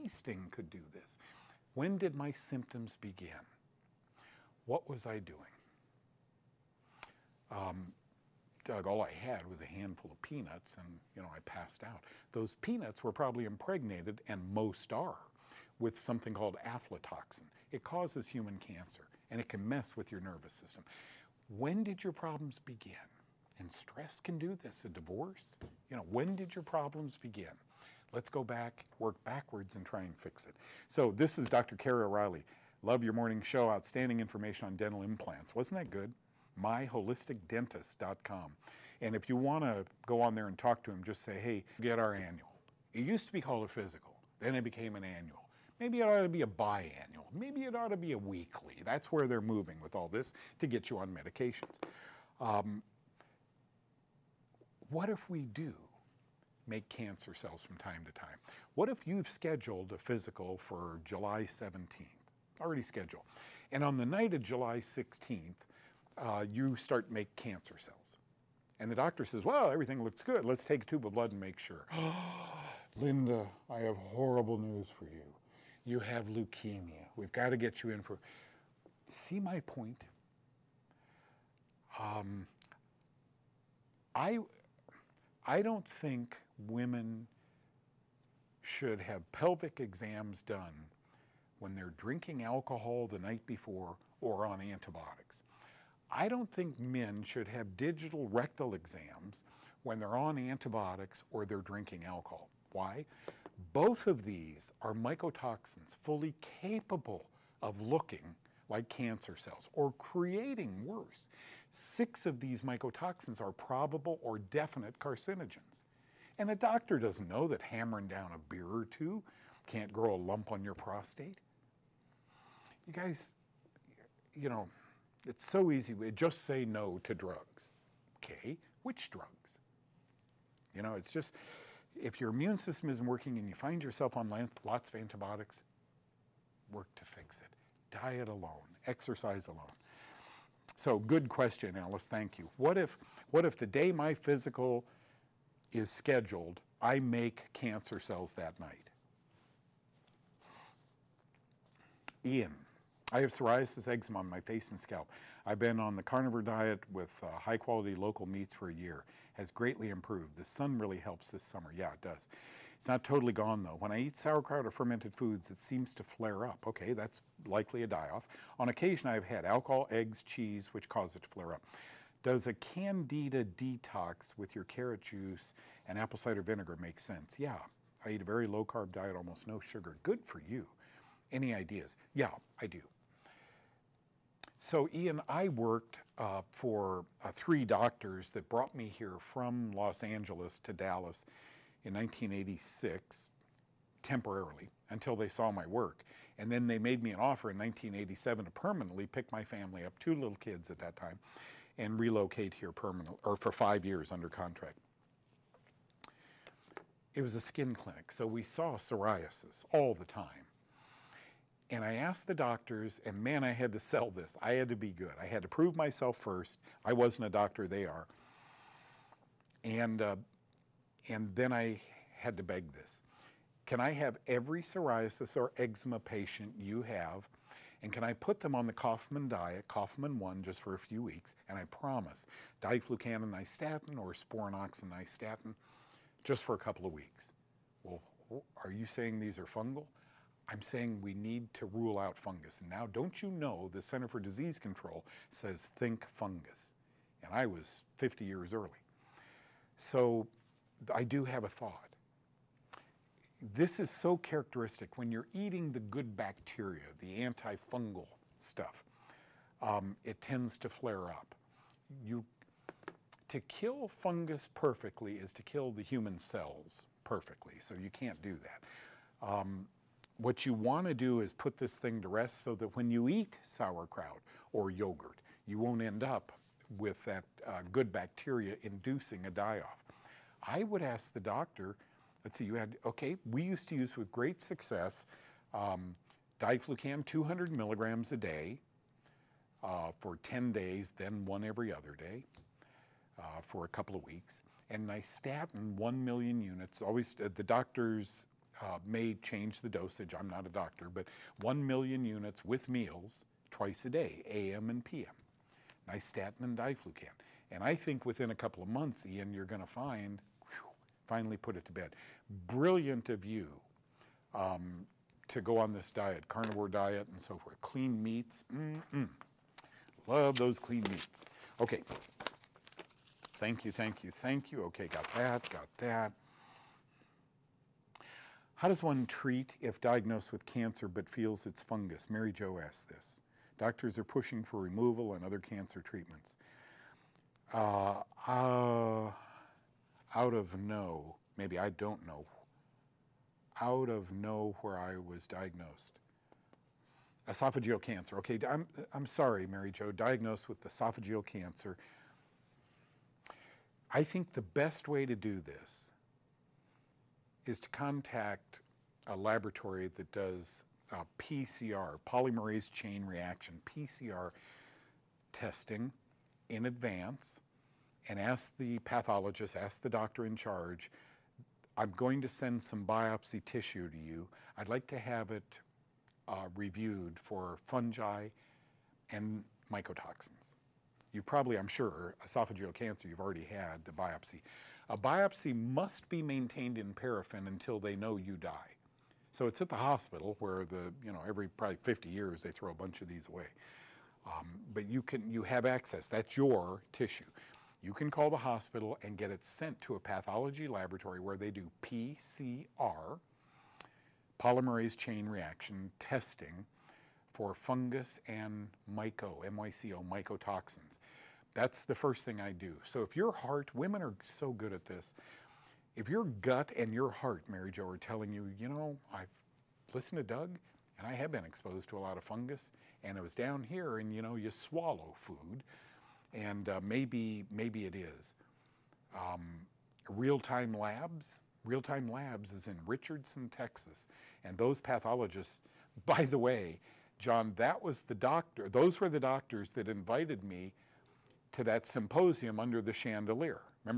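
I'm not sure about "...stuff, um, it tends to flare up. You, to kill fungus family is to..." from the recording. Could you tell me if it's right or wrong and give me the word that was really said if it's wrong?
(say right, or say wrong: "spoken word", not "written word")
wrong: "perfectly", not "family".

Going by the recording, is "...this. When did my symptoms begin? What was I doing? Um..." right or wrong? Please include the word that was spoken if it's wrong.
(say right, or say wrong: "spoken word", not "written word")
right.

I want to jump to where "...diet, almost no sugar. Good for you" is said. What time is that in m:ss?
2:58.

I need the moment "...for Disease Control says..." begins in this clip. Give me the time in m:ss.
4:04.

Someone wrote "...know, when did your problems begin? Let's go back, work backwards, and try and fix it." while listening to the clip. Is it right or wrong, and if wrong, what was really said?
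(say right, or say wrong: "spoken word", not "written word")
right.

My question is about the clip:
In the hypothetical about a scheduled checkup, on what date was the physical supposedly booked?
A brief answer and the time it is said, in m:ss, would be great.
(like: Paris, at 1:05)
July 17th, at 1:01.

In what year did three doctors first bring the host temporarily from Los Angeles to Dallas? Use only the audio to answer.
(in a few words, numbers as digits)
1986.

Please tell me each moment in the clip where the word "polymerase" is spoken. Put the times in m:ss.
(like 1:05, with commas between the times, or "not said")
6:02, 6:44.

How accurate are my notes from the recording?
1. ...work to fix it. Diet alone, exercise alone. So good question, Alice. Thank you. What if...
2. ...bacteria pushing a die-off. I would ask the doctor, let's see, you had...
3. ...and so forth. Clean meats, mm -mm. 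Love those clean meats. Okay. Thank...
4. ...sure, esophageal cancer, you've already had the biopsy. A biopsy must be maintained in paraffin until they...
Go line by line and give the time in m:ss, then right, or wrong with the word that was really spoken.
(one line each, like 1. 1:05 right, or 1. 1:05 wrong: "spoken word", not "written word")
1. 2:16 right
2. 4:37 wrong: "inducing", not "pushing"
3. 5:17 right
4. 6:21 right.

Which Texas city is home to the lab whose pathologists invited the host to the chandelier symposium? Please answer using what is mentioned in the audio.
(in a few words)
Richardson.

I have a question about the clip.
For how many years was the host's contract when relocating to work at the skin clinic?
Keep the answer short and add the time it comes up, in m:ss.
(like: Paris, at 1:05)
5, at 3:23.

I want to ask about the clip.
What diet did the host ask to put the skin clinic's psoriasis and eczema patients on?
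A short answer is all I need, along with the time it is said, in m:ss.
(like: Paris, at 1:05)
Kaufmann diet, at 3:48.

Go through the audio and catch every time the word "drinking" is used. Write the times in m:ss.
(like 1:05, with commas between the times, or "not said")
1:31, 1:41.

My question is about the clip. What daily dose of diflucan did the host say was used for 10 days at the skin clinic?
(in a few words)
200 milligrams.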